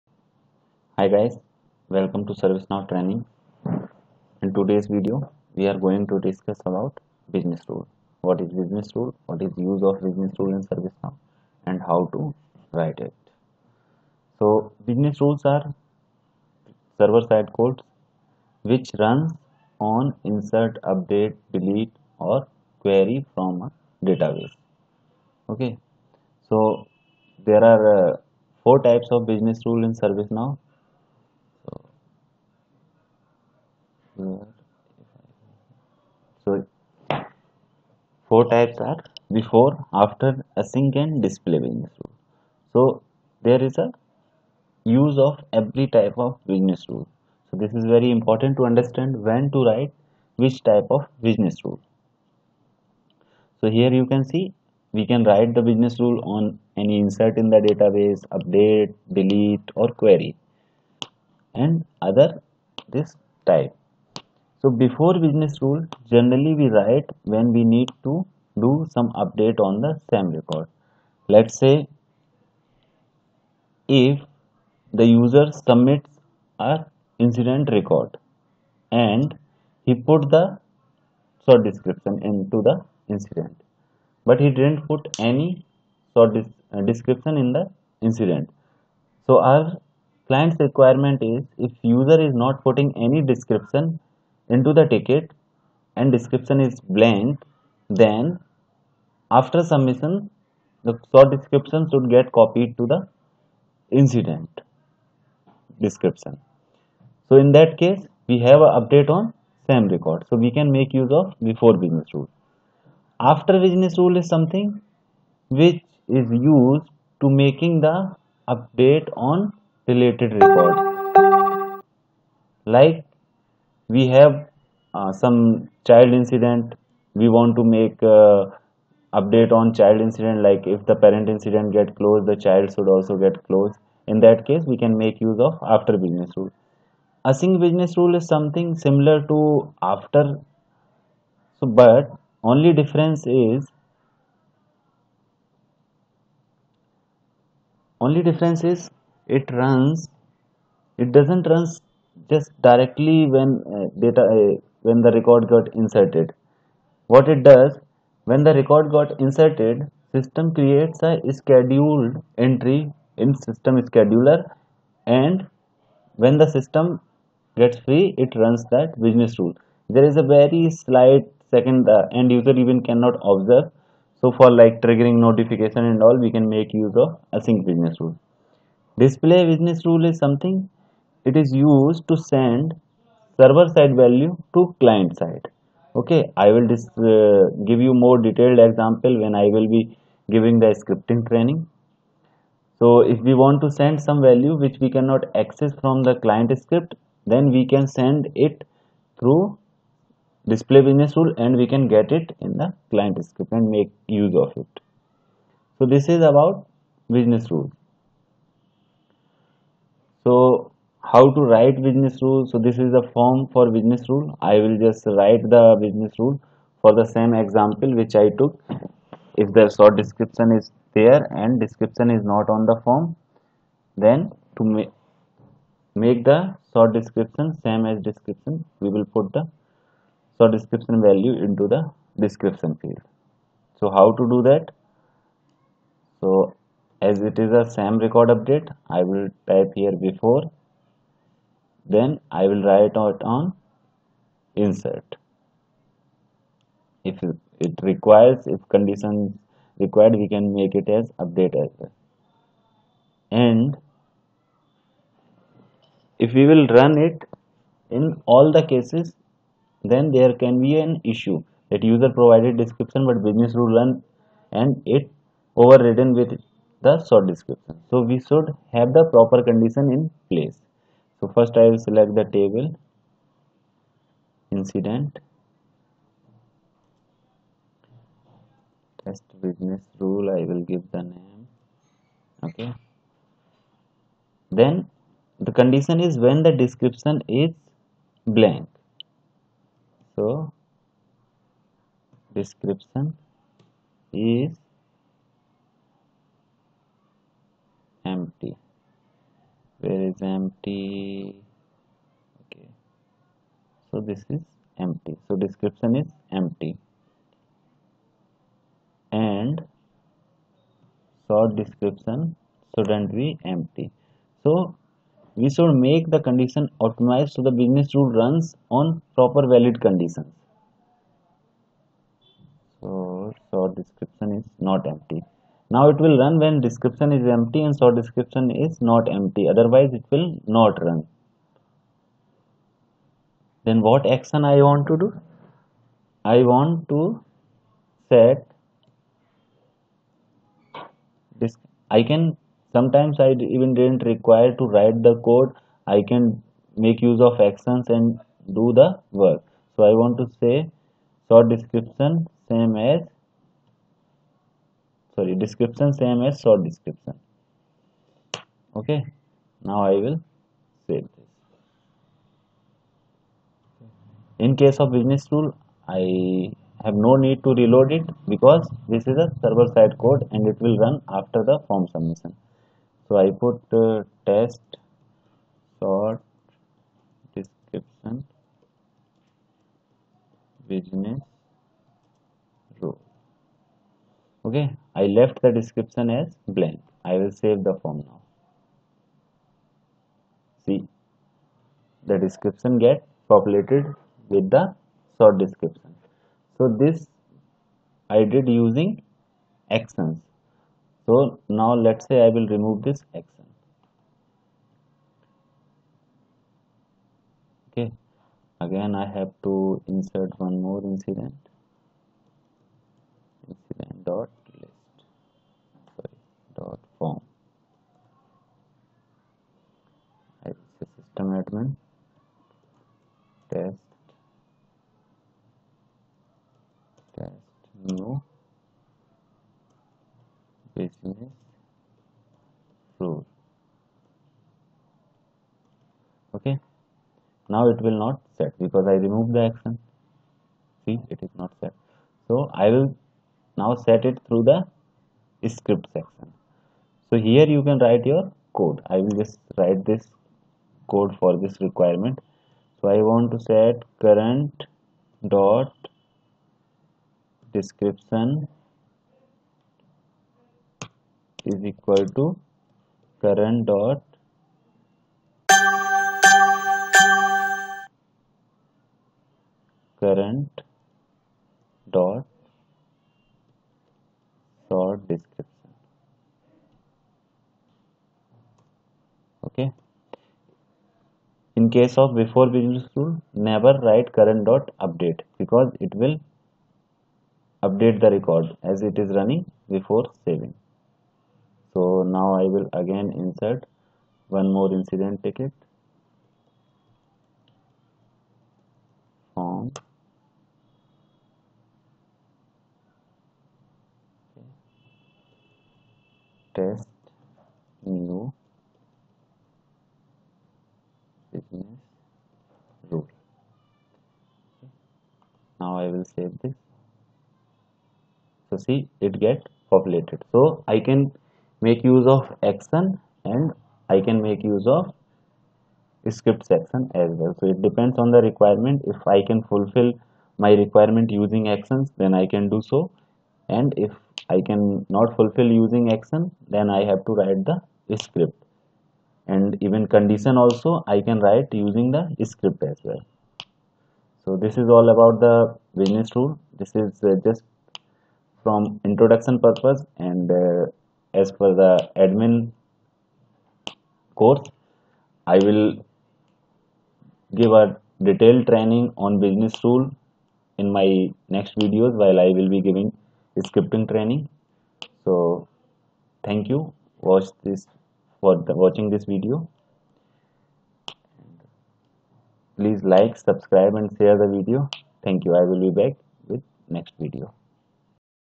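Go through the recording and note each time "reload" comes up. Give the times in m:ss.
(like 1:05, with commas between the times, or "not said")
6:07.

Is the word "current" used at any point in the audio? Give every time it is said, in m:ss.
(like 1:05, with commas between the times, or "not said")
7:34, 7:43, 7:50, 8:04.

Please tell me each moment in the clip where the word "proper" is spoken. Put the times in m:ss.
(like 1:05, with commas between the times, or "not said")
4:29, 5:19.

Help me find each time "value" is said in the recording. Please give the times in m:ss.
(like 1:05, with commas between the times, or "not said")
3:03, 3:14, 3:51.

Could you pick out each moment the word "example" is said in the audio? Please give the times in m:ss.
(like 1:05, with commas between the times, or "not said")
3:08, 3:37.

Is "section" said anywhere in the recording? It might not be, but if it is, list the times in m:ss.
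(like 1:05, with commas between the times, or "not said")
7:25, 8:46.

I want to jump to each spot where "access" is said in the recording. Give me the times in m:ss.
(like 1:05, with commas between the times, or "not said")
3:15.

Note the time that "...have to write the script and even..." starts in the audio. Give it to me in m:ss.
8:56.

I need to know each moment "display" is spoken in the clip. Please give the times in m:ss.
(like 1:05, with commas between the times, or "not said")
0:41, 2:58, 3:20.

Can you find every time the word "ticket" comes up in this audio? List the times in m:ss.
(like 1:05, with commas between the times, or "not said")
1:34, 8:15.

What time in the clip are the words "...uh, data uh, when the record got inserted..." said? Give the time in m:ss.
2:33.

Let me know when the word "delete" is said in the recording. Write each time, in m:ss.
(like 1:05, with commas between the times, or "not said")
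0:21, 0:59.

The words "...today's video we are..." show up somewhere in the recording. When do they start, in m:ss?
0:04.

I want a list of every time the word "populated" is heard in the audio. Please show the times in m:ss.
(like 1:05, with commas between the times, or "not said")
6:33, 8:39.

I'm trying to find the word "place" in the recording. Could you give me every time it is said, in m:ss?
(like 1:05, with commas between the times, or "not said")
4:30.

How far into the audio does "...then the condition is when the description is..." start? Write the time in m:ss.
4:44.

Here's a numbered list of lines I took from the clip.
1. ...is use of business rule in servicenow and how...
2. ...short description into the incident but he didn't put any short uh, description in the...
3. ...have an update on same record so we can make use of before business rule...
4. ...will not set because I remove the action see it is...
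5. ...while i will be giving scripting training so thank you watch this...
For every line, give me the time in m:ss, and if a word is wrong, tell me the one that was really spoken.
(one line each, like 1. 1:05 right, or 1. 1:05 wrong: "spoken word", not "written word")
1. 0:09 right
2. 1:21 right
3. 1:48 right
4. 7:17 right
5. 9:22 right.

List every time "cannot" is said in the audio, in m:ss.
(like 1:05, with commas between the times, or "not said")
2:52, 3:14.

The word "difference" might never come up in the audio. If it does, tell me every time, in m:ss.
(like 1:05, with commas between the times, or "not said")
2:22, 2:28.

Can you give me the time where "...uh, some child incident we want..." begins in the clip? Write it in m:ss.
2:04.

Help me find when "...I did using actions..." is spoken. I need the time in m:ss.
6:38.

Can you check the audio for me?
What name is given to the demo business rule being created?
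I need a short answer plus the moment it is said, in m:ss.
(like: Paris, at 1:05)
test business rule, at 4:39.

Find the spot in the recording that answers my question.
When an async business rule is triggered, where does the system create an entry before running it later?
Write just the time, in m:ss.
2:43.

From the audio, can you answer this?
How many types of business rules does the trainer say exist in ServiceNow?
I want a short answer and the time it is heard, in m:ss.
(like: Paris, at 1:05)
4, at 0:28.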